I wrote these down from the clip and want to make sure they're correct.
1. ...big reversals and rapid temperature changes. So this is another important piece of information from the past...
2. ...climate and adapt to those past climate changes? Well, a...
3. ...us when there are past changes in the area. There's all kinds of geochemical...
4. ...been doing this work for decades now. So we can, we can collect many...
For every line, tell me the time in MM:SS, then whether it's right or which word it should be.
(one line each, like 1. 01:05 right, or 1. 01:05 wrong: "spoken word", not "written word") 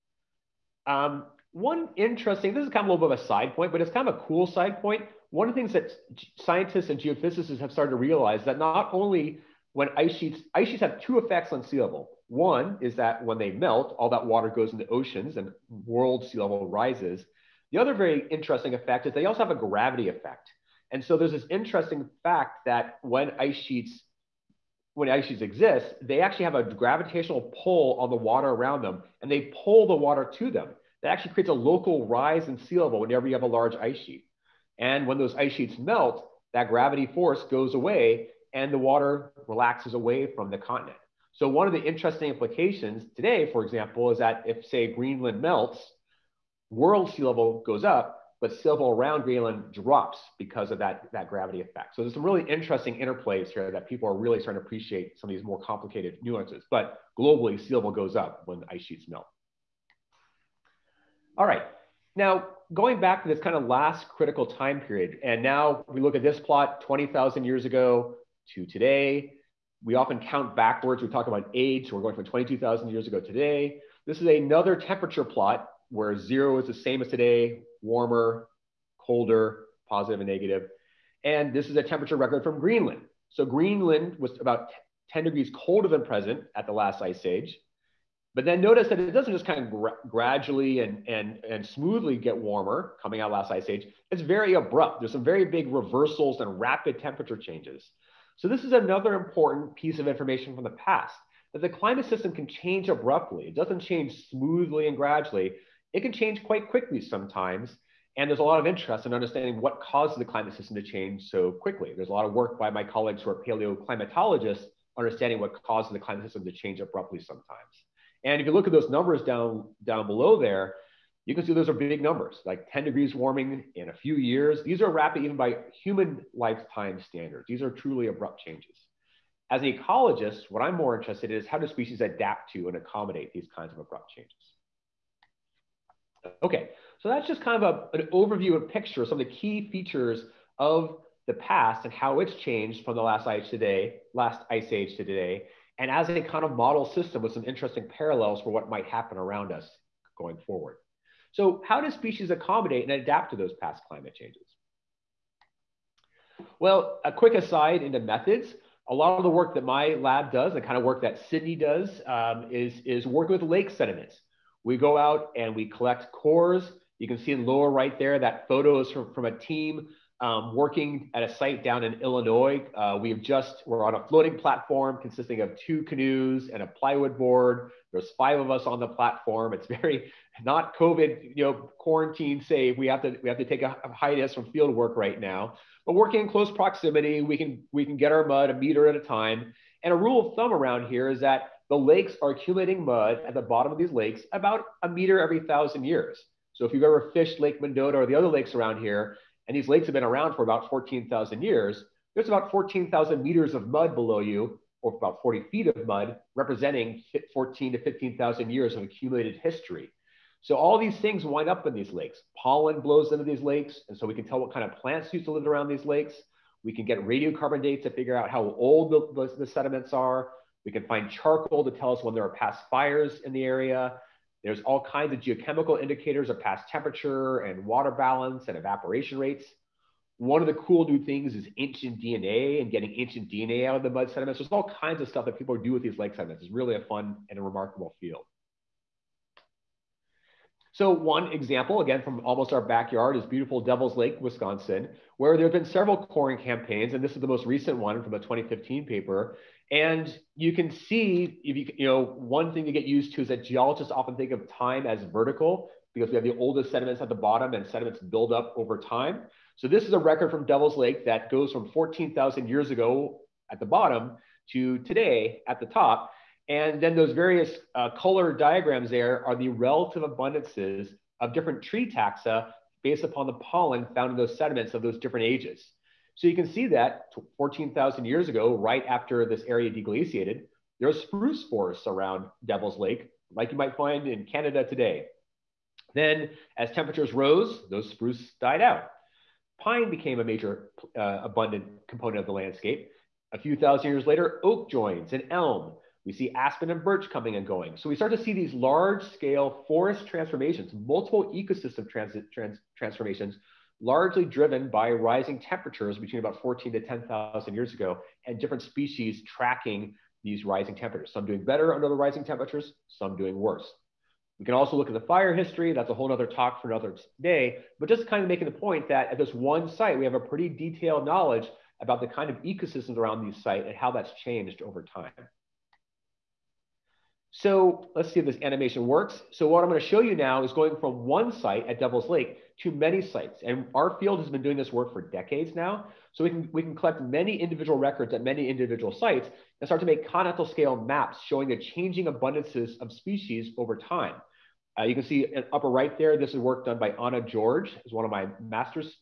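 1. 01:35 right
2. 02:32 wrong: "accommodate", not "climate"
3. 03:41 wrong: "fires", not "changes"
4. 05:34 right.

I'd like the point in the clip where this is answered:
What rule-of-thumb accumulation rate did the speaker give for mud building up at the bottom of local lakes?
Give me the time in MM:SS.
03:14.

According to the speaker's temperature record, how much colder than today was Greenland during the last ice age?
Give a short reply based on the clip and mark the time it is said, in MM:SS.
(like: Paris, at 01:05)
10 degrees, at 01:25.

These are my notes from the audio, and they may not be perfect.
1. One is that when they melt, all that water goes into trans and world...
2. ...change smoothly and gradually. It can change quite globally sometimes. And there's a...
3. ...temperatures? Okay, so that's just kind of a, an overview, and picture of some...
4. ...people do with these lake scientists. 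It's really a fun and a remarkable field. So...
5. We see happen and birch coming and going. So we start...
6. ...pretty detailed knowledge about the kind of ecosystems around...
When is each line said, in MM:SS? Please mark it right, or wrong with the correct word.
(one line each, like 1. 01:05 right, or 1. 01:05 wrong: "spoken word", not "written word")
1. 00:12 wrong: "oceans", not "trans"
2. 01:43 wrong: "quickly", not "globally"
3. 02:14 wrong: "changes", not "temperatures"
4. 03:55 wrong: "sediments", not "scientists"
5. 04:56 wrong: "aspen", not "happen"
6. 05:20 right.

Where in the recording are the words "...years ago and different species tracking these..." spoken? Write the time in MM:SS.
05:07.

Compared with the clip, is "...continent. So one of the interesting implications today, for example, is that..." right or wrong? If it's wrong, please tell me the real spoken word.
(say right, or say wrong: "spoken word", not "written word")
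right.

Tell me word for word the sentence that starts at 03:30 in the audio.
So all these things wind up in these lakes.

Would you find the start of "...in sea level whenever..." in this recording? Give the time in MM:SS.
00:32.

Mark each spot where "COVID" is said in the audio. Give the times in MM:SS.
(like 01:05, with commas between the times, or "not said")
03:00.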